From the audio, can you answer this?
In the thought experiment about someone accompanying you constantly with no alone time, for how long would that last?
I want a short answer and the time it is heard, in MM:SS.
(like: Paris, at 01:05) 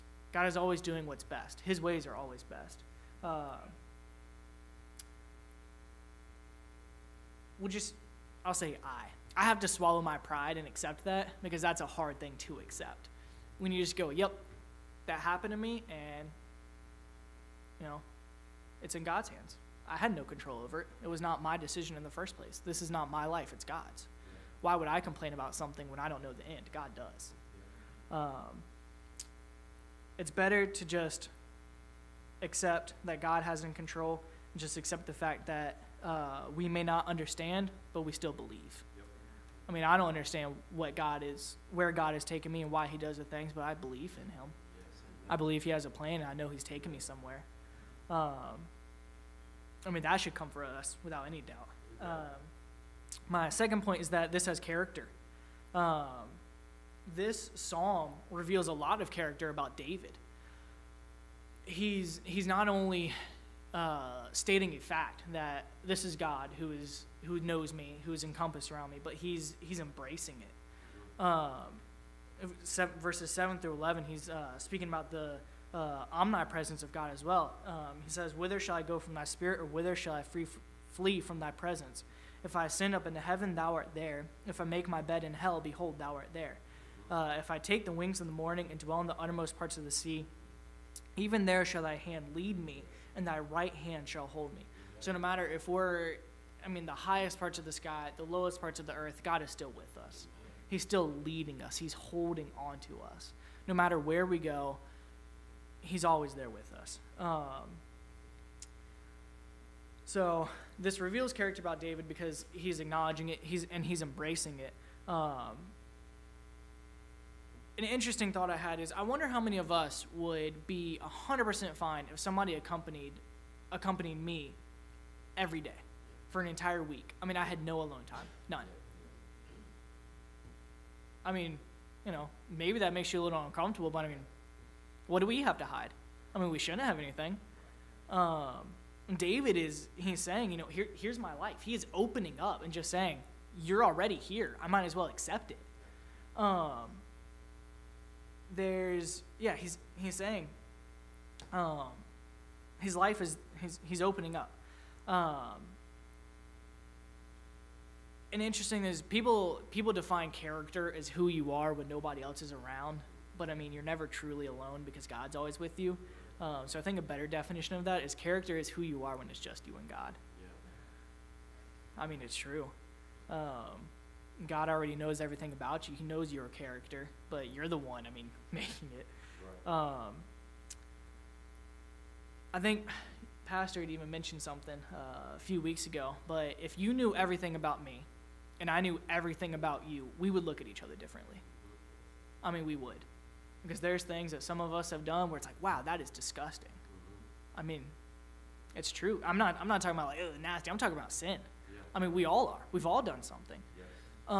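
An entire week, at 02:06.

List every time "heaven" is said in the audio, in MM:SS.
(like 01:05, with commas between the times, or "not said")
01:23.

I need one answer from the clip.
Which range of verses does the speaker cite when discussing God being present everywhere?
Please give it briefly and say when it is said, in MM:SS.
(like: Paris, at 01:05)
7 through 11, at 01:13.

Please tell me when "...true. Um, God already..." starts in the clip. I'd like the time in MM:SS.
02:52.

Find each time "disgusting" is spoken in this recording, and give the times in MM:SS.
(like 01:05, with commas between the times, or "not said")
03:16.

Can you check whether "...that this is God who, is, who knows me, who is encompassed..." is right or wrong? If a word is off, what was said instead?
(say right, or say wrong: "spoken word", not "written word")
right.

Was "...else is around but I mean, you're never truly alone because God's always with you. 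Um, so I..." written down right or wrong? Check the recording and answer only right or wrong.
right.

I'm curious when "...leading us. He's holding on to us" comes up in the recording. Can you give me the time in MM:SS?
01:41.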